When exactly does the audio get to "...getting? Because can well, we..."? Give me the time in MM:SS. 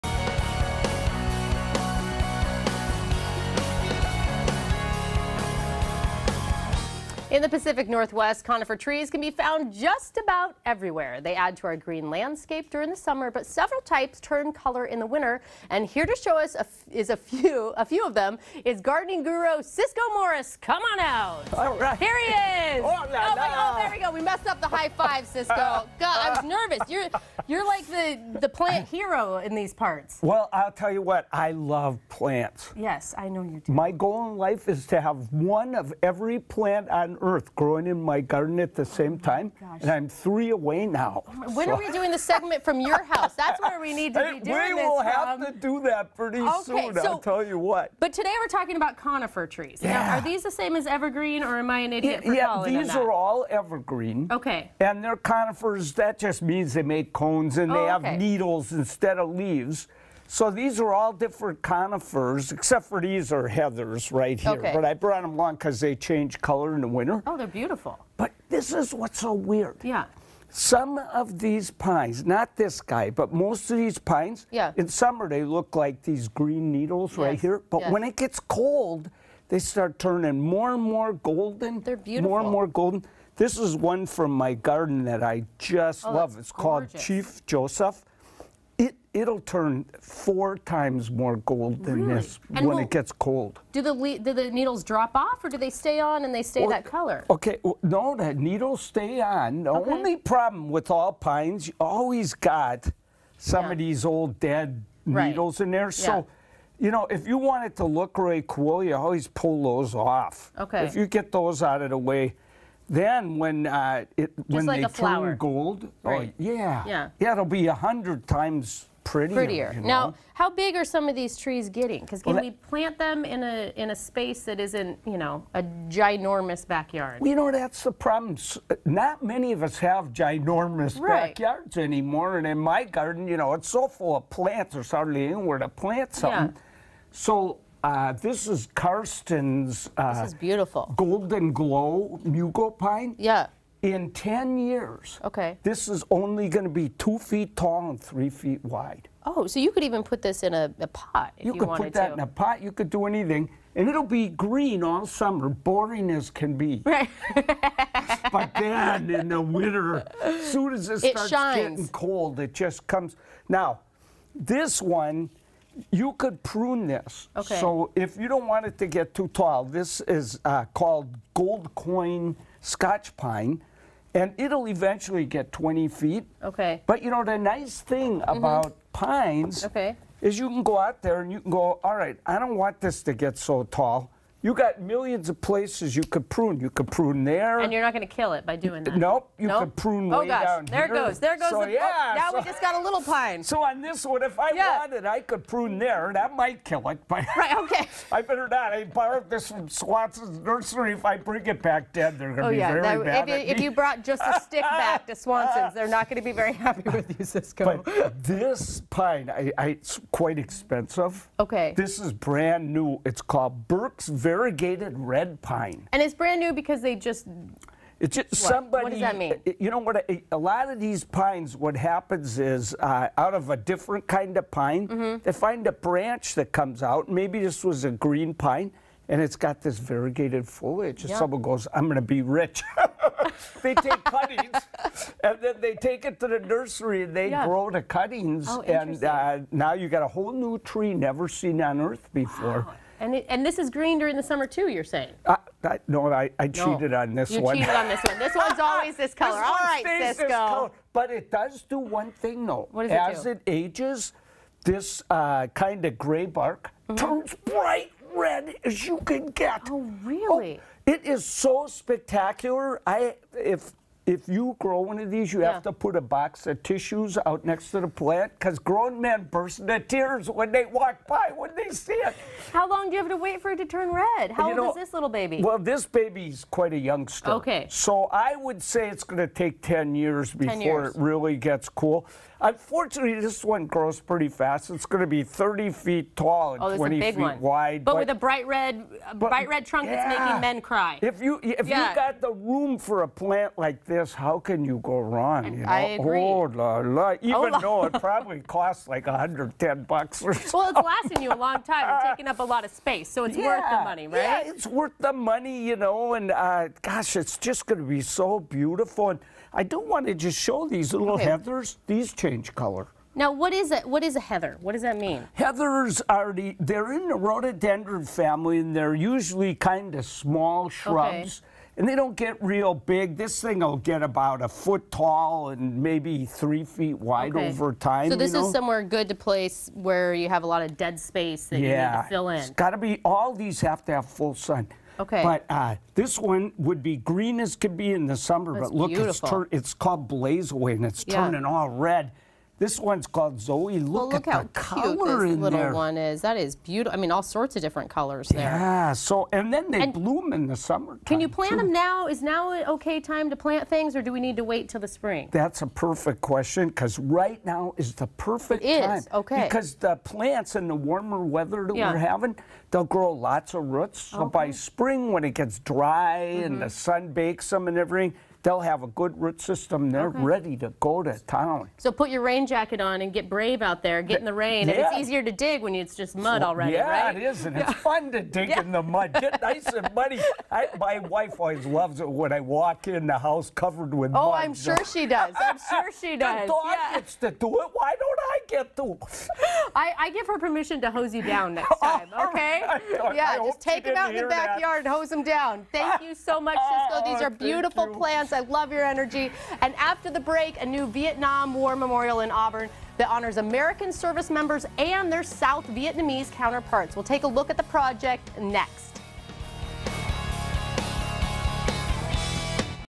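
02:01.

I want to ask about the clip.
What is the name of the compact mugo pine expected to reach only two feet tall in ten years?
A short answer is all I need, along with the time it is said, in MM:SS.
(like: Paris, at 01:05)
Golden Glow Mugo Pine, at 02:20.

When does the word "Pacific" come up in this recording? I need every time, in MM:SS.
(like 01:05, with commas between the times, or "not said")
00:07.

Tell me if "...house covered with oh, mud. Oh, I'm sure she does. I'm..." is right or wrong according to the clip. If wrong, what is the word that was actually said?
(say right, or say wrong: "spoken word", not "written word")
right.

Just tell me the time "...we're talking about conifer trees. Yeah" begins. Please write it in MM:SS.
00:48.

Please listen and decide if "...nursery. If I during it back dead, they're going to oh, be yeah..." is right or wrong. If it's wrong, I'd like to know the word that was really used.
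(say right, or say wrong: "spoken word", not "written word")
wrong: "bring", not "during".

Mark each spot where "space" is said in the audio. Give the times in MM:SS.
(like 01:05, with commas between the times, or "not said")
02:03, 05:02, 05:30.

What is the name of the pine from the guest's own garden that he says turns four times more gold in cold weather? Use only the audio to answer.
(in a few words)
Chief Joseph.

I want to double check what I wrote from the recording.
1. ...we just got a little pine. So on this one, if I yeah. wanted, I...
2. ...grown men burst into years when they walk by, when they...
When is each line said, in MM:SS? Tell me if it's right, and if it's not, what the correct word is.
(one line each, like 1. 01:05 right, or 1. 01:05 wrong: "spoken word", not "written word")
1. 03:12 right
2. 04:28 wrong: "tears", not "years".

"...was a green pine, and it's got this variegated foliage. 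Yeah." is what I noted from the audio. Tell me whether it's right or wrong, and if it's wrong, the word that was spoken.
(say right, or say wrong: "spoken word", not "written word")
right.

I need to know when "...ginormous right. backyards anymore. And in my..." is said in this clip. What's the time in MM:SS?
02:10.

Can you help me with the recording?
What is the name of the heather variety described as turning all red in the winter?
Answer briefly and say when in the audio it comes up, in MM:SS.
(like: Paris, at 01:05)
Blaze Away, at 05:40.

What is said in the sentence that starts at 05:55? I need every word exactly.
That's a perfect question because right now is the perfect it time.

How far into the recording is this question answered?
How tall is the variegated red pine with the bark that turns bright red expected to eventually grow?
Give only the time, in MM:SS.
04:45.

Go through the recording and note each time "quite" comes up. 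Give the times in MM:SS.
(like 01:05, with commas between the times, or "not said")
03:30, 04:36.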